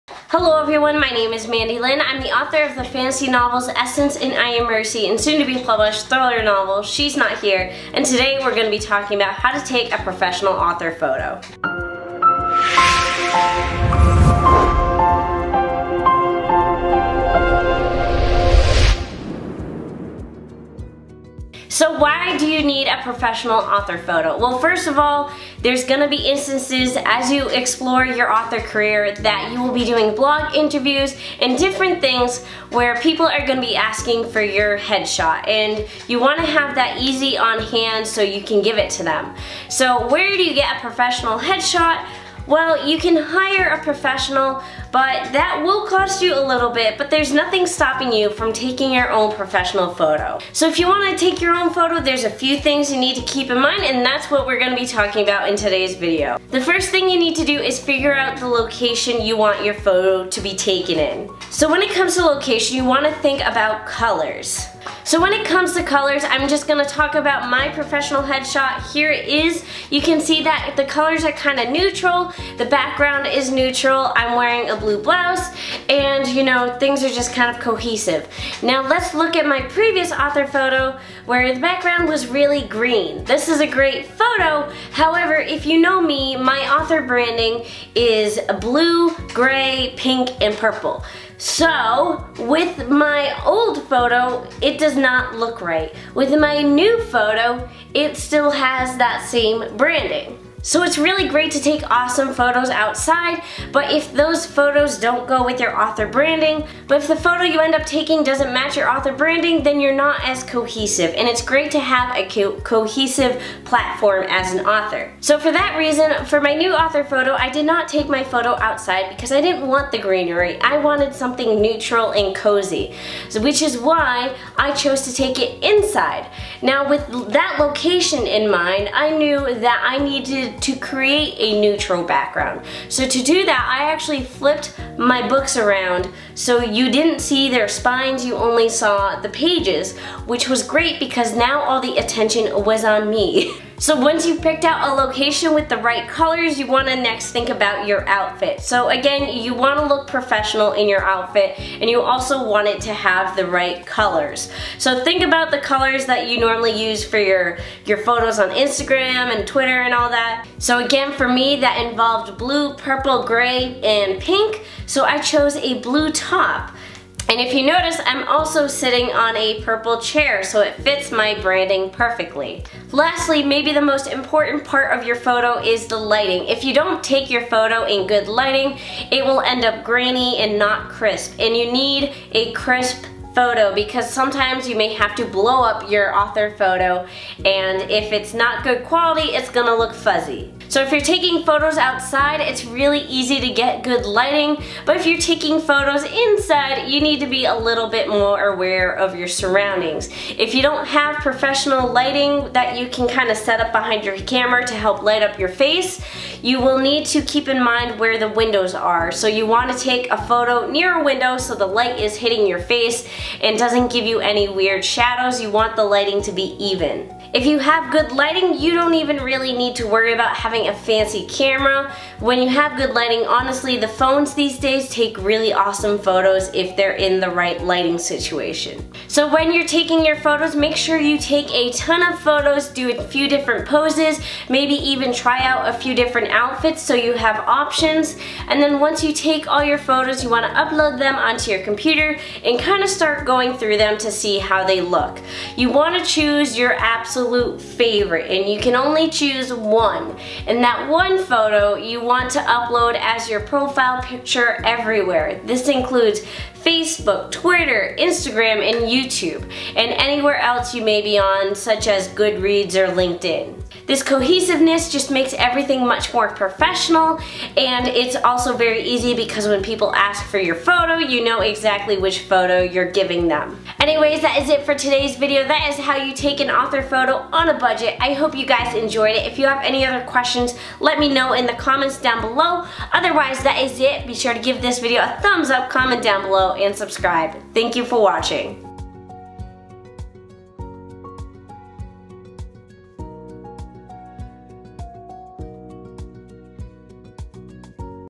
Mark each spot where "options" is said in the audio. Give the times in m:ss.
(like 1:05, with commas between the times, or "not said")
3:57.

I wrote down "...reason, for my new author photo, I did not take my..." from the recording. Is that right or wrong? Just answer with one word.
right.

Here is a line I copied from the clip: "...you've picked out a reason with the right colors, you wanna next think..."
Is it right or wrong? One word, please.
wrong.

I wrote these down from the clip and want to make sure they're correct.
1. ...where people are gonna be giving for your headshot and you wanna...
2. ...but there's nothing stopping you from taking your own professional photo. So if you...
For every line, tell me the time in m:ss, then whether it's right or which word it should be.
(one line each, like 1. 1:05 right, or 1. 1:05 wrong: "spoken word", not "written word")
1. 0:32 wrong: "asking", not "giving"
2. 0:46 right.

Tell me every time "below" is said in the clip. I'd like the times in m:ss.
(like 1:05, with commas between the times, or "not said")
4:42, 4:46.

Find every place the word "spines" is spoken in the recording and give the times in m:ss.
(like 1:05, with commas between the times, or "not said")
2:17.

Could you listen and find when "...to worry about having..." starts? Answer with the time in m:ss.
3:39.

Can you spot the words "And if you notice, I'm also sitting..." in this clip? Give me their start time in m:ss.
2:47.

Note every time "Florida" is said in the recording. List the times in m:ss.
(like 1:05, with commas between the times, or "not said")
not said.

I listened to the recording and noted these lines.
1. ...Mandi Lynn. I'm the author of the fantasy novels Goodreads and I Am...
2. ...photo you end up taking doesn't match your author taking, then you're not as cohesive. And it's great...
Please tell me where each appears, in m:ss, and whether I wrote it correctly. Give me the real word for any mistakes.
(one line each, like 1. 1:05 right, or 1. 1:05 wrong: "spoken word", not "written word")
1. 0:01 wrong: "Essence", not "Goodreads"
2. 1:47 wrong: "branding", not "taking".